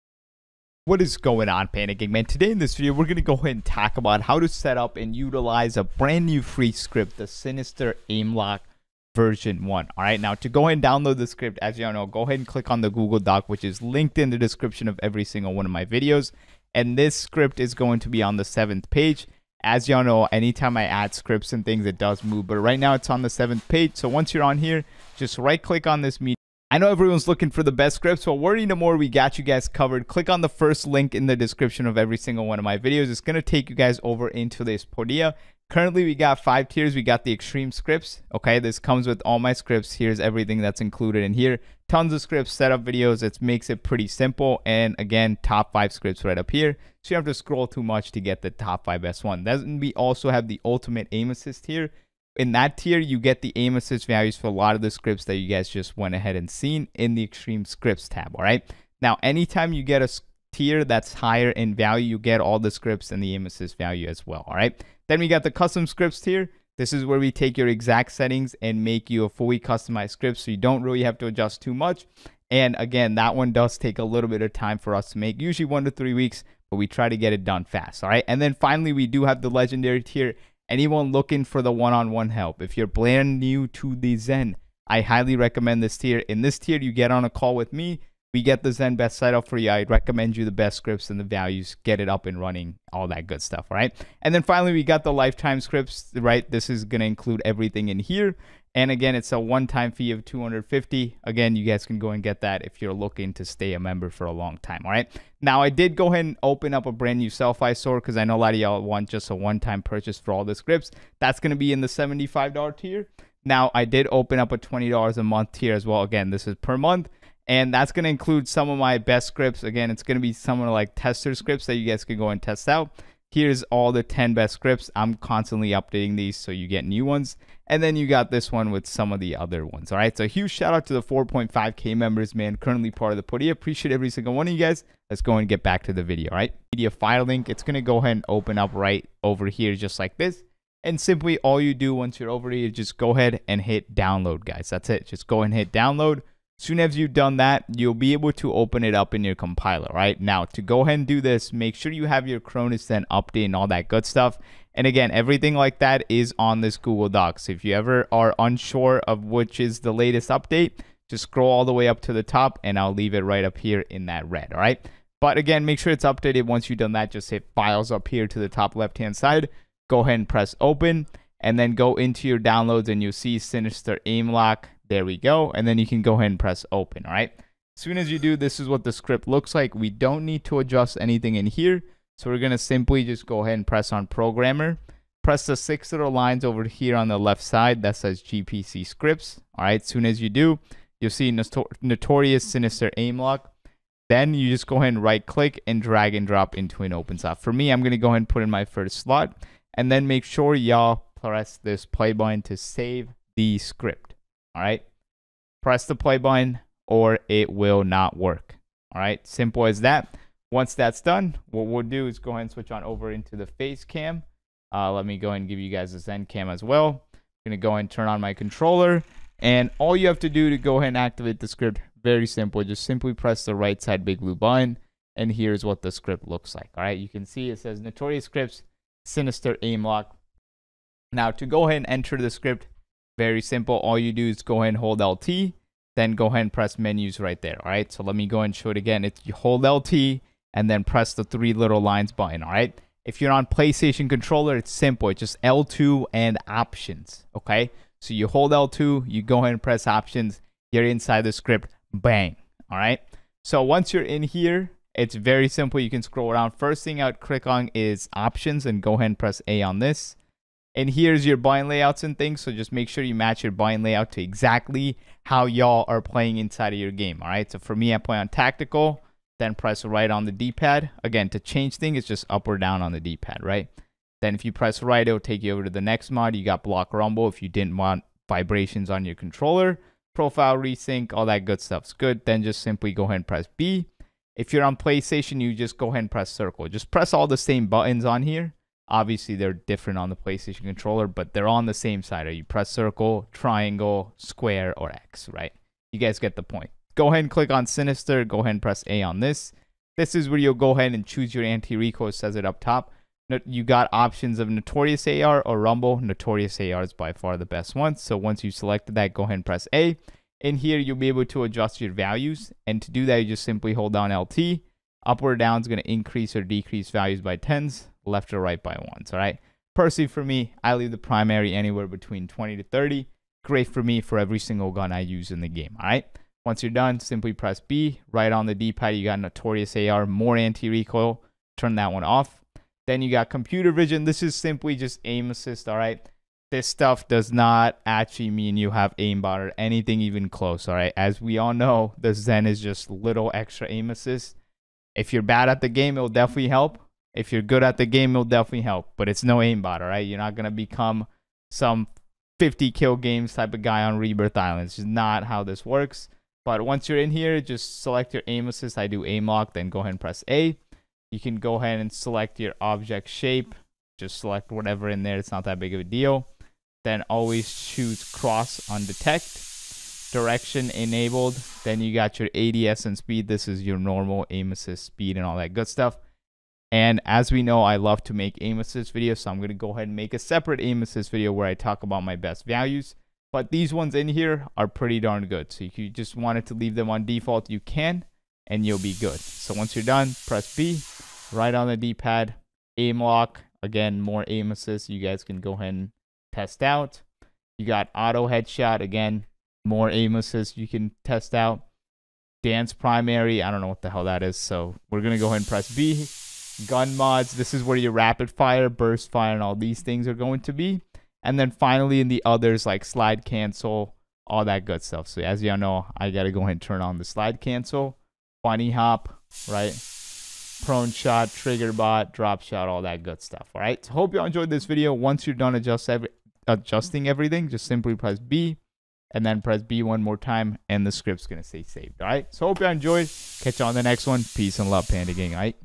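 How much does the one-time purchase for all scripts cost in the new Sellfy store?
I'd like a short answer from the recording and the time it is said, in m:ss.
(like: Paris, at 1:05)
$75, at 1:51.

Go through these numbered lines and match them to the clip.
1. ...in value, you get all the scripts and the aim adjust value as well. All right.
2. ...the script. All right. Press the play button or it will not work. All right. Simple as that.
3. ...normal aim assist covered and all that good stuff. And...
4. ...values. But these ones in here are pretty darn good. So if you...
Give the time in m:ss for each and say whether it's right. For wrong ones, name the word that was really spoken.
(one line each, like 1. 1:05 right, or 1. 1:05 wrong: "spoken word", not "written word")
1. 1:01 wrong: "assist", not "adjust"
2. 3:23 right
3. 6:13 wrong: "speed", not "covered"
4. 6:22 right.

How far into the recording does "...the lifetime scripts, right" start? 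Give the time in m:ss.
1:35.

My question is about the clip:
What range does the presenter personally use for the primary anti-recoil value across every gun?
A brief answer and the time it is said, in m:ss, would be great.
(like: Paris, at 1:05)
20 to 30, at 5:22.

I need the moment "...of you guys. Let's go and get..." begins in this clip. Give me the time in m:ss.
2:14.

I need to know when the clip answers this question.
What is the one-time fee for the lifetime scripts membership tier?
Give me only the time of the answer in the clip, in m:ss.
1:40.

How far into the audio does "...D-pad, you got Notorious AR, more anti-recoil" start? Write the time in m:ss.
5:28.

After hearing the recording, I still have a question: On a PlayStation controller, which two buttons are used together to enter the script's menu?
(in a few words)
L2 and options.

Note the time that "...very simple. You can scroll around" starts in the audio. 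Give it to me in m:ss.
4:15.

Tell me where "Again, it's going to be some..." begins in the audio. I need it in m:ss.
1:59.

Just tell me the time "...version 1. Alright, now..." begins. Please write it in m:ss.
0:09.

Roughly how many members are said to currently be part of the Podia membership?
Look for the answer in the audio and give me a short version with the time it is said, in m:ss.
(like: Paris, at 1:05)
4.5K, at 2:11.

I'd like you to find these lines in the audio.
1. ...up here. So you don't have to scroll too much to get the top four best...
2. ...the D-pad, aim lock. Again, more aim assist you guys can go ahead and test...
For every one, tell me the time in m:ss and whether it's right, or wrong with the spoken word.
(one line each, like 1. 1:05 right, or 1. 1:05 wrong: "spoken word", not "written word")
1. 0:46 wrong: "five", not "four"
2. 6:31 right.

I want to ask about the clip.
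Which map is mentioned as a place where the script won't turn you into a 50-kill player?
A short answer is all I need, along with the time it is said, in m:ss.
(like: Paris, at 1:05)
Rebirth Island, at 5:53.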